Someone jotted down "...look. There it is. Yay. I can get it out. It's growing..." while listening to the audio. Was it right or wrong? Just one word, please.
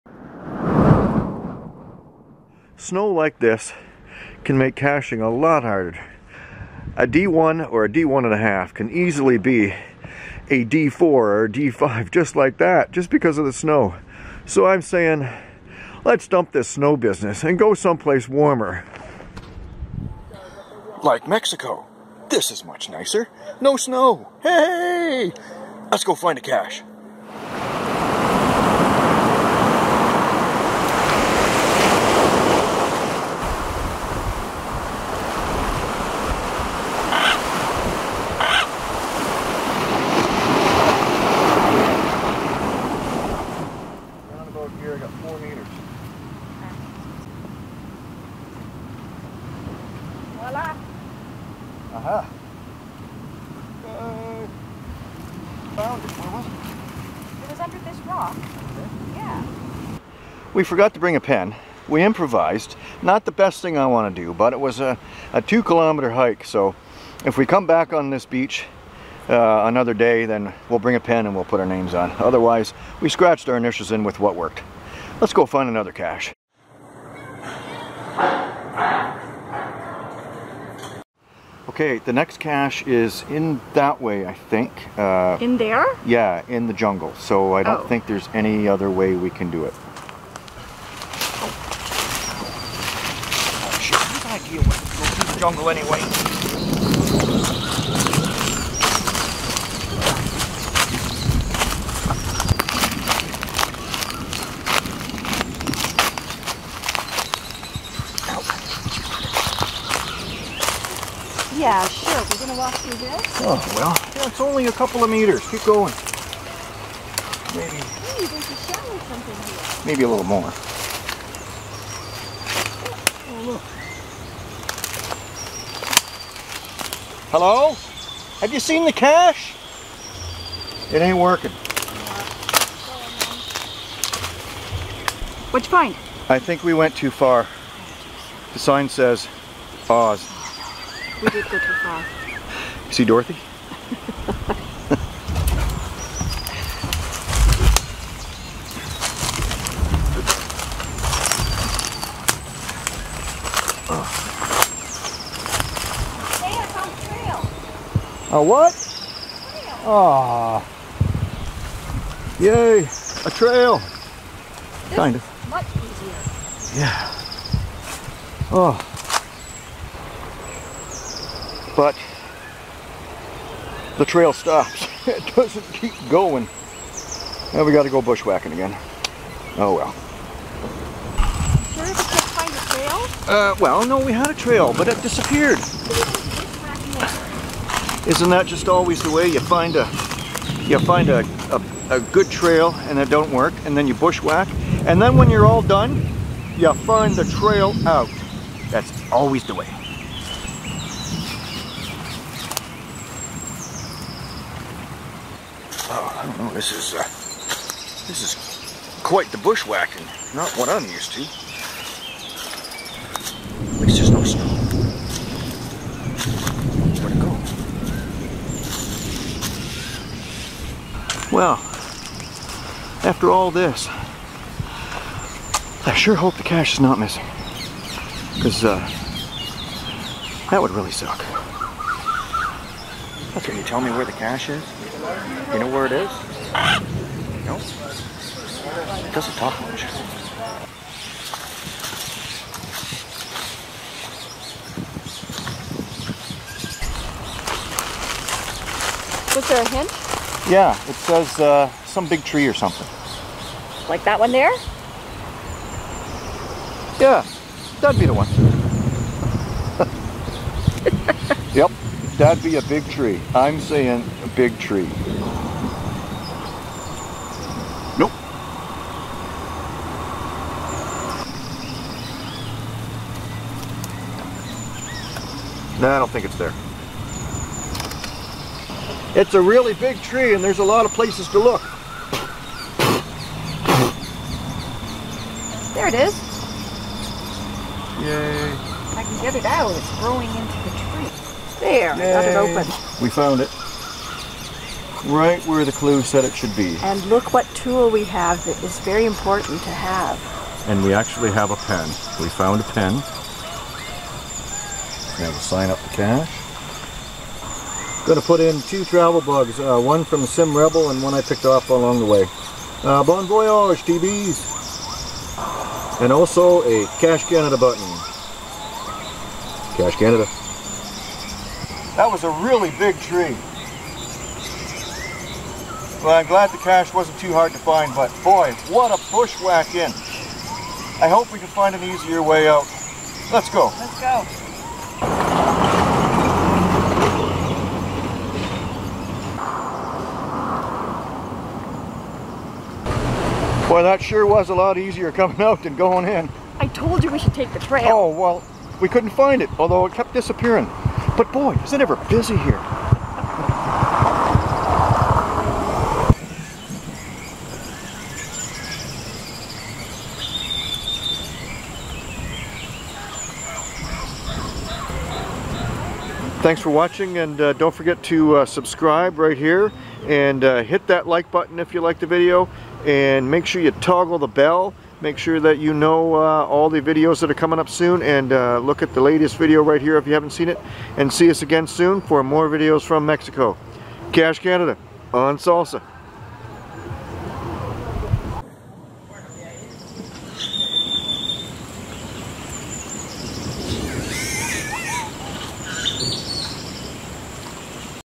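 right.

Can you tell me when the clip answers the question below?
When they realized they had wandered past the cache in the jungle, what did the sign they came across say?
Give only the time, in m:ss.
2:19.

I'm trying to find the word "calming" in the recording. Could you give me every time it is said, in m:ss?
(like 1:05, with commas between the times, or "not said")
not said.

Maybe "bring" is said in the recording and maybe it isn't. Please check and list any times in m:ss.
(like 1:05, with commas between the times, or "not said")
1:00, 1:10.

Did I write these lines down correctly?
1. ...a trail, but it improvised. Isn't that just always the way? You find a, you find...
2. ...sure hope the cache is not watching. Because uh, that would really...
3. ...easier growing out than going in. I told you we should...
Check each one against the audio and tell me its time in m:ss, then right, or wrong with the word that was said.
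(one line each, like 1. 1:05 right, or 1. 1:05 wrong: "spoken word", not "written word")
1. 3:04 wrong: "disappeared", not "improvised"
2. 3:45 wrong: "missing", not "watching"
3. 5:44 wrong: "coming", not "growing".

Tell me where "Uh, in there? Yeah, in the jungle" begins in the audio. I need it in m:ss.
1:24.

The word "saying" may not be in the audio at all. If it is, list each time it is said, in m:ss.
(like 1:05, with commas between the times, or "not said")
0:14, 4:23.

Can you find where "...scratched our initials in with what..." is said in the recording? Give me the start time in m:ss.
1:13.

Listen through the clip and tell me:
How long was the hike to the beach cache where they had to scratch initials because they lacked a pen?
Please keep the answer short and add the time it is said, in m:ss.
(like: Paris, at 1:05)
2 kilometers, at 1:05.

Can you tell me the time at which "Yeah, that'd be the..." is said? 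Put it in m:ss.
4:16.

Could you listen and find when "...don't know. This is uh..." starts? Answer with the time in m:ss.
3:26.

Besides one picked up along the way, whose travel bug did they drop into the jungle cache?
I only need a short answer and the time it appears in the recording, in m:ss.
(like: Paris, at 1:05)
Sim Rebel, at 5:10.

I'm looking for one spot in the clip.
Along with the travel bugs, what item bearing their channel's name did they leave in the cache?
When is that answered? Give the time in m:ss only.
5:16.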